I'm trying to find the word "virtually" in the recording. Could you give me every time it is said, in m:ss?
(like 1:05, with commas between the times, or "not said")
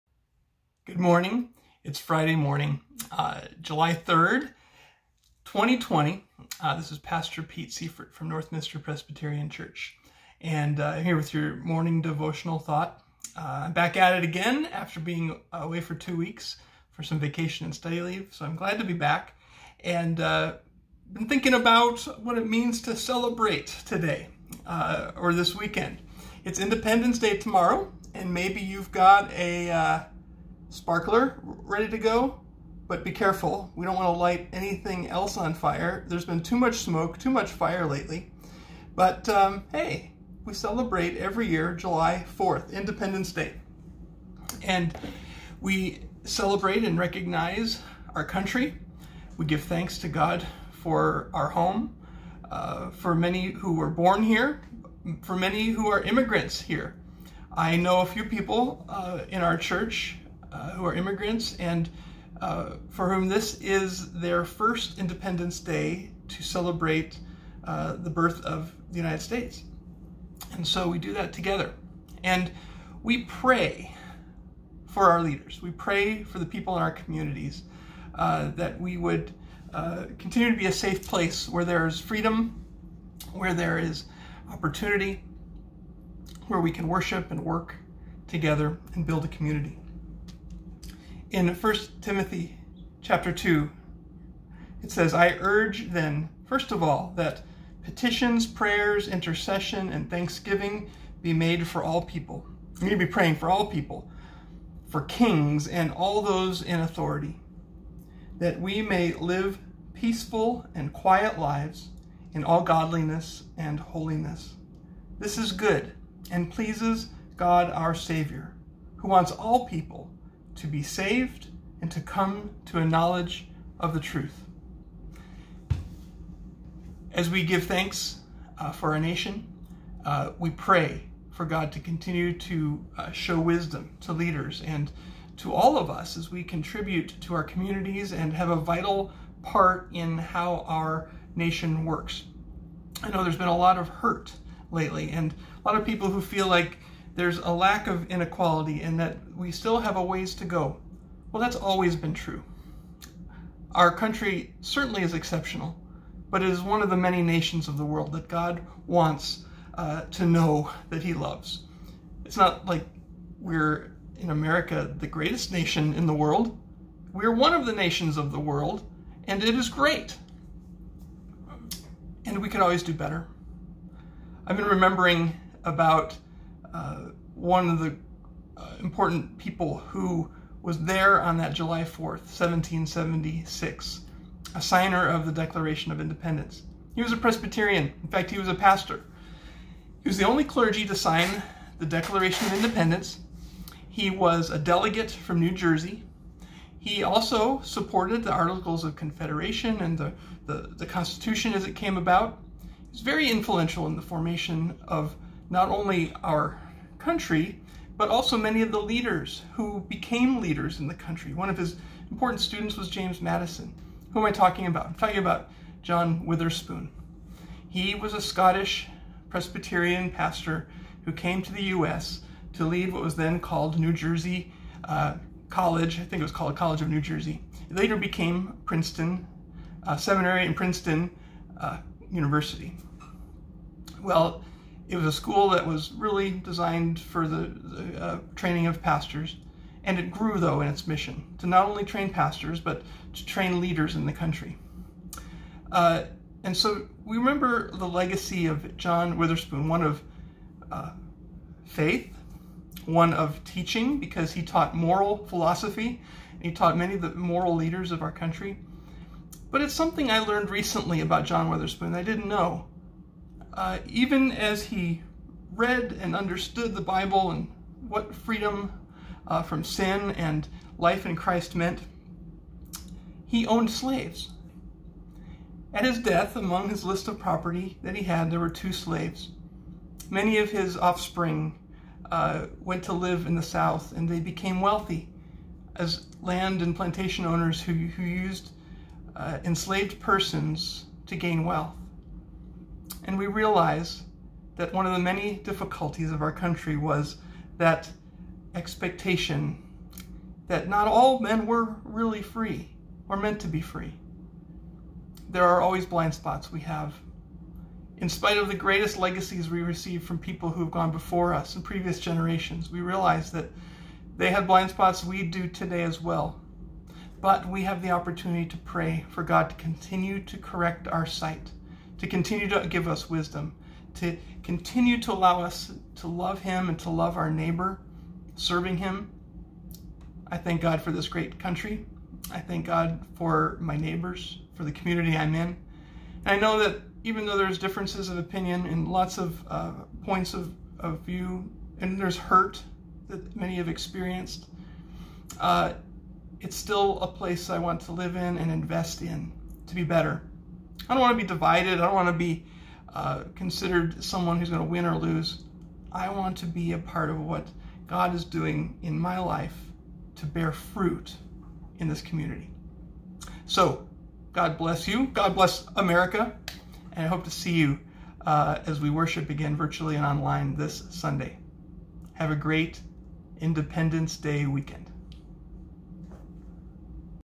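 6:09.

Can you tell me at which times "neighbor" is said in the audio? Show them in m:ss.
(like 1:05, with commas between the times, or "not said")
5:27, 5:33.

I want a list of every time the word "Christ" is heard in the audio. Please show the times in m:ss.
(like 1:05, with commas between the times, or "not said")
4:31.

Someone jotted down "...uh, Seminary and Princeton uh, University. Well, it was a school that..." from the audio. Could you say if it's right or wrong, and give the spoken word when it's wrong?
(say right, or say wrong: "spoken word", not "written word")
right.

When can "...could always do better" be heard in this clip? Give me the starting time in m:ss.
2:52.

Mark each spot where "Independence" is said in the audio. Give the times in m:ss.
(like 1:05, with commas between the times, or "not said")
0:26, 0:42, 1:04, 3:05, 3:12, 6:13.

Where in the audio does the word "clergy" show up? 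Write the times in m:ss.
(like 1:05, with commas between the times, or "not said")
3:10.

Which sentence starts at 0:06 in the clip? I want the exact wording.
Uh, this is Pastor Pete Seiferth from Northminster Presbyterian Church.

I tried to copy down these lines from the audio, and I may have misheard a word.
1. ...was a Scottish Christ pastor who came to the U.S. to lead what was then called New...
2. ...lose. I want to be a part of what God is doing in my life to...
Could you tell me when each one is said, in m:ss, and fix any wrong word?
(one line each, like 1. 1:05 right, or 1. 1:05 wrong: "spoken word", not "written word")
1. 3:37 wrong: "Presbyterian", not "Christ"
2. 5:54 right.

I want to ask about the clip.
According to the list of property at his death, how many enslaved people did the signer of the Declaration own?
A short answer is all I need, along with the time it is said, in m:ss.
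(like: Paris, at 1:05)
2, at 4:38.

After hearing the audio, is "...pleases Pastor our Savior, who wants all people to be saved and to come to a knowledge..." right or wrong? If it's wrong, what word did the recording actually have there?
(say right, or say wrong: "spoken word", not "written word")
wrong: "God", not "Pastor".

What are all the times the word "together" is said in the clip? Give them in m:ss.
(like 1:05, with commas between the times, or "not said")
1:11, 1:28.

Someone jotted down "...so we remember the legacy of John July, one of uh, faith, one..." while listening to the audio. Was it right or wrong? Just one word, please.
wrong.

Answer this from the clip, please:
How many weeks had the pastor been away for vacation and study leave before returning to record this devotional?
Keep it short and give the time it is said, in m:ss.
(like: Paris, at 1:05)
2, at 0:15.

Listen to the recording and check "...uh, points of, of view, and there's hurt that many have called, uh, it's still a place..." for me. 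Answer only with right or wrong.
wrong.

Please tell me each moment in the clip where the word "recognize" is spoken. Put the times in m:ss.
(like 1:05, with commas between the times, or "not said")
0:46.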